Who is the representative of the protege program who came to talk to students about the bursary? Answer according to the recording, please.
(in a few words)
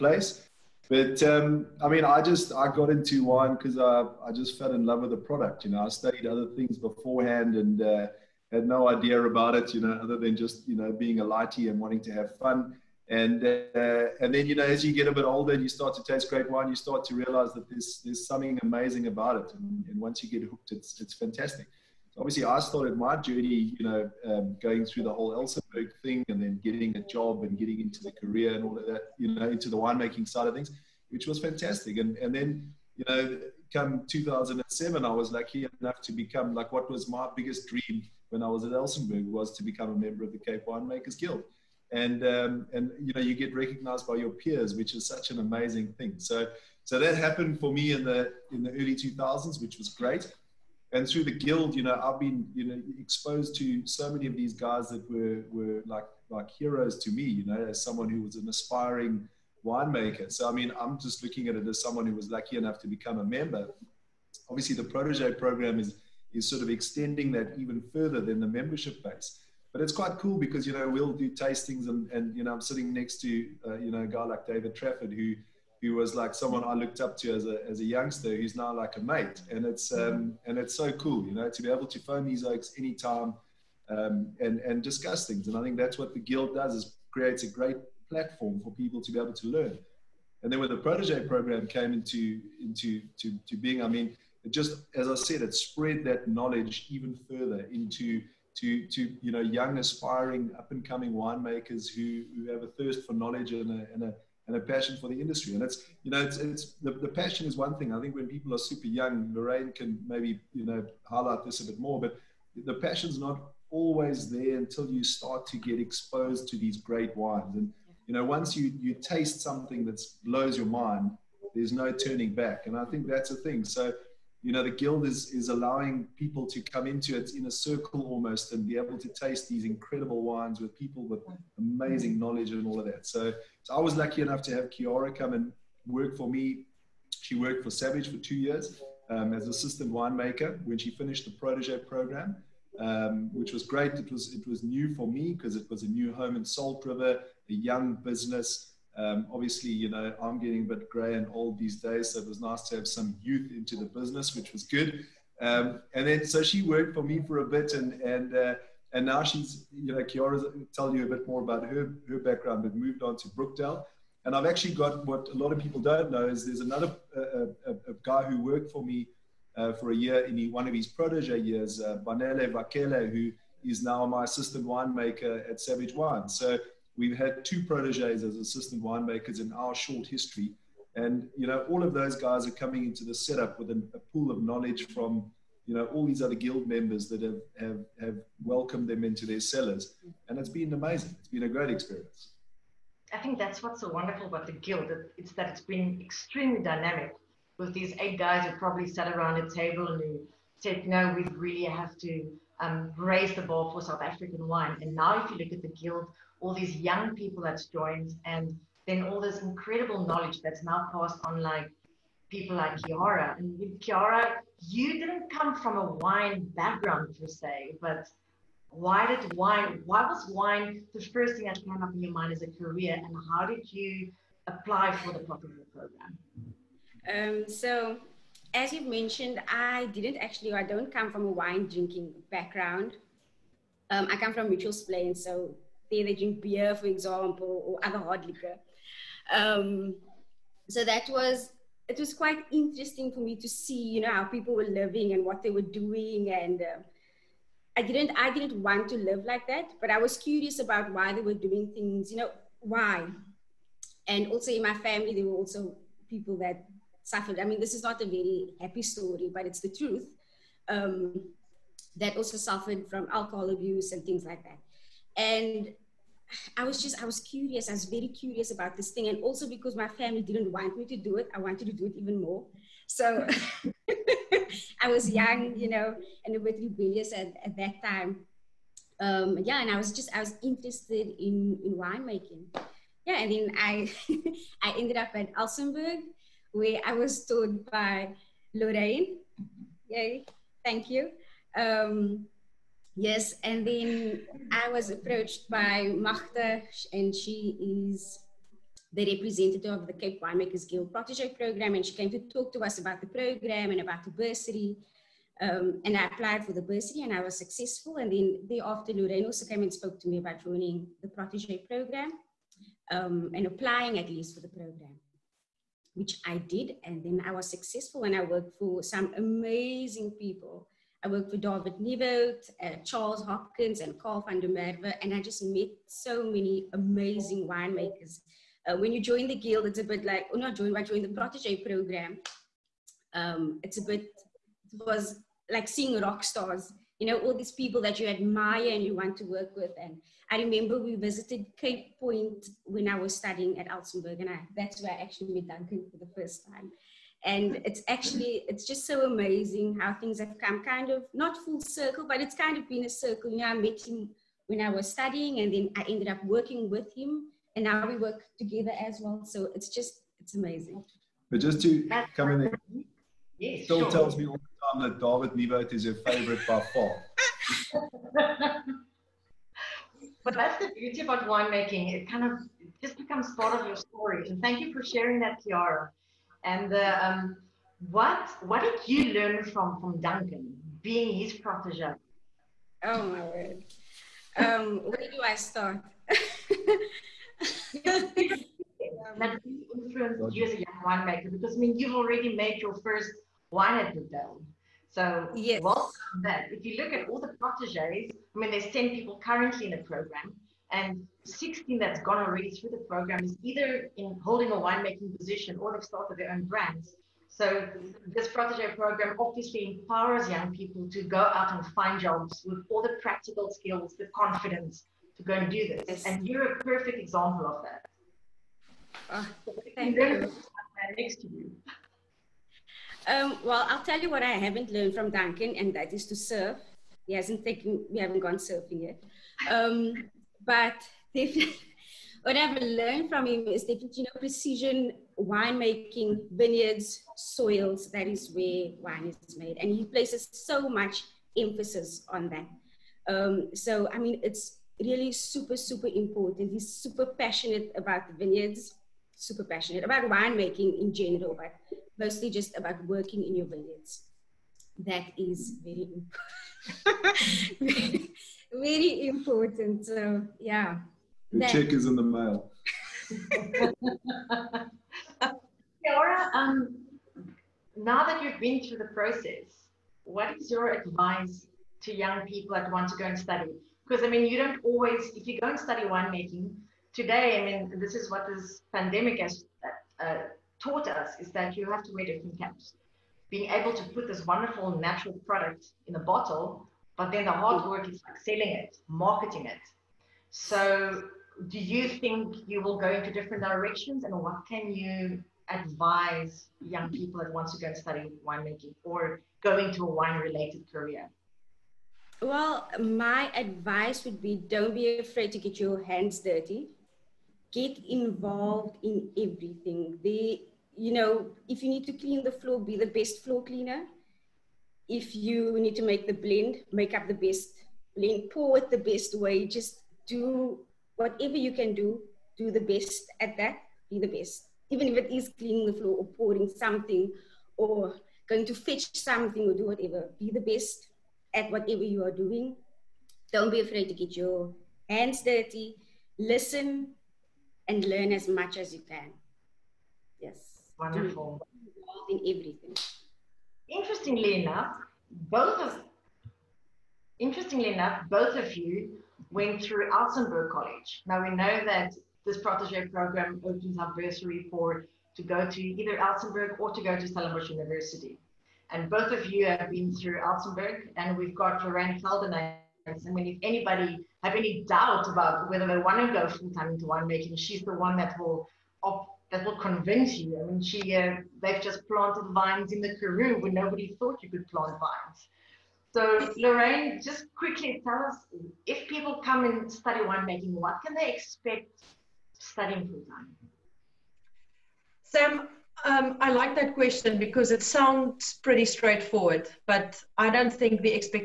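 Magda.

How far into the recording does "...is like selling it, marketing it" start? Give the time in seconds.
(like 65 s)
487 s.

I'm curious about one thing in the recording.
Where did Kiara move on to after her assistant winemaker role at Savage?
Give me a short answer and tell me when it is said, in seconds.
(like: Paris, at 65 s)
Brookdale, at 163 s.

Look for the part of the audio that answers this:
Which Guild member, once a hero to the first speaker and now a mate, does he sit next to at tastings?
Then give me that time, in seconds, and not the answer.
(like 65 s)
74 s.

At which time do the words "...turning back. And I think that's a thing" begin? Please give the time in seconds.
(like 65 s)
121 s.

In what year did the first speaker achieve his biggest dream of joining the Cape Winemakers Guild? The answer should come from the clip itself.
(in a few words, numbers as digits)
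2007.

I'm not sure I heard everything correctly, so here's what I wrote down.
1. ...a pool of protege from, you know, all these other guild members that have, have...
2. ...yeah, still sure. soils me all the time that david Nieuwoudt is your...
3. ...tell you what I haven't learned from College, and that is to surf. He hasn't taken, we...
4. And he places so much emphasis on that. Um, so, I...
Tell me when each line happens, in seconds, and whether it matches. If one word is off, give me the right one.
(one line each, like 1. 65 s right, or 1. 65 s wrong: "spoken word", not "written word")
1. 183 s wrong: "knowledge", not "protege"
2. 363 s wrong: "tells", not "soils"
3. 423 s wrong: "Duncan", not "College"
4. 439 s right.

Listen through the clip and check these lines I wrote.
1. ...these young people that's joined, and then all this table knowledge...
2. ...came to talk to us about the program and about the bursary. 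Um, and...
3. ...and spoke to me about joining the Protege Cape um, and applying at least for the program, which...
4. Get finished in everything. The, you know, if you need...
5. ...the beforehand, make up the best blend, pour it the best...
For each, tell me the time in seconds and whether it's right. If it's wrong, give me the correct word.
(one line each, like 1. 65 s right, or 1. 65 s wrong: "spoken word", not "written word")
1. 206 s wrong: "incredible", not "table"
2. 301 s right
3. 309 s wrong: "Program", not "Cape"
4. 507 s wrong: "involved", not "finished"
5. 516 s wrong: "blend", not "beforehand".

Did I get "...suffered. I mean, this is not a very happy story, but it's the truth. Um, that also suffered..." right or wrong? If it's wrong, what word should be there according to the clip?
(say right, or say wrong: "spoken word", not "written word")
right.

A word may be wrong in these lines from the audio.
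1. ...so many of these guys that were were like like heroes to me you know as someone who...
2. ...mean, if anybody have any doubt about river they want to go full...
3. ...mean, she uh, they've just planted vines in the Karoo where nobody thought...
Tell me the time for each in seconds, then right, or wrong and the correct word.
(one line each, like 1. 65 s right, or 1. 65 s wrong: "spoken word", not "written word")
1. 53 s right
2. 563 s wrong: "whether", not "river"
3. 570 s right.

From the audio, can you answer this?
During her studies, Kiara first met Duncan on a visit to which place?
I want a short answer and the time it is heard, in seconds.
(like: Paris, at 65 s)
Cape Point, at 341 s.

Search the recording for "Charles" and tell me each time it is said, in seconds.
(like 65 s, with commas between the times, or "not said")
322 s.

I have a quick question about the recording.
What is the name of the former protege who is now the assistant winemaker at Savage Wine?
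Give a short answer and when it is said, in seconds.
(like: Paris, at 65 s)
Banele Vakele, at 172 s.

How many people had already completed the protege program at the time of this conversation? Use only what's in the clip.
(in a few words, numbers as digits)
16.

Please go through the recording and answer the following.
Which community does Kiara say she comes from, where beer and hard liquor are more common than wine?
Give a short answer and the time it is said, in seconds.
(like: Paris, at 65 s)
Mitchells Plain, at 234 s.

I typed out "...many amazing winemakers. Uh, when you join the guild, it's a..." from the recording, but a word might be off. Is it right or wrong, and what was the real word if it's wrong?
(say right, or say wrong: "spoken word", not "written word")
right.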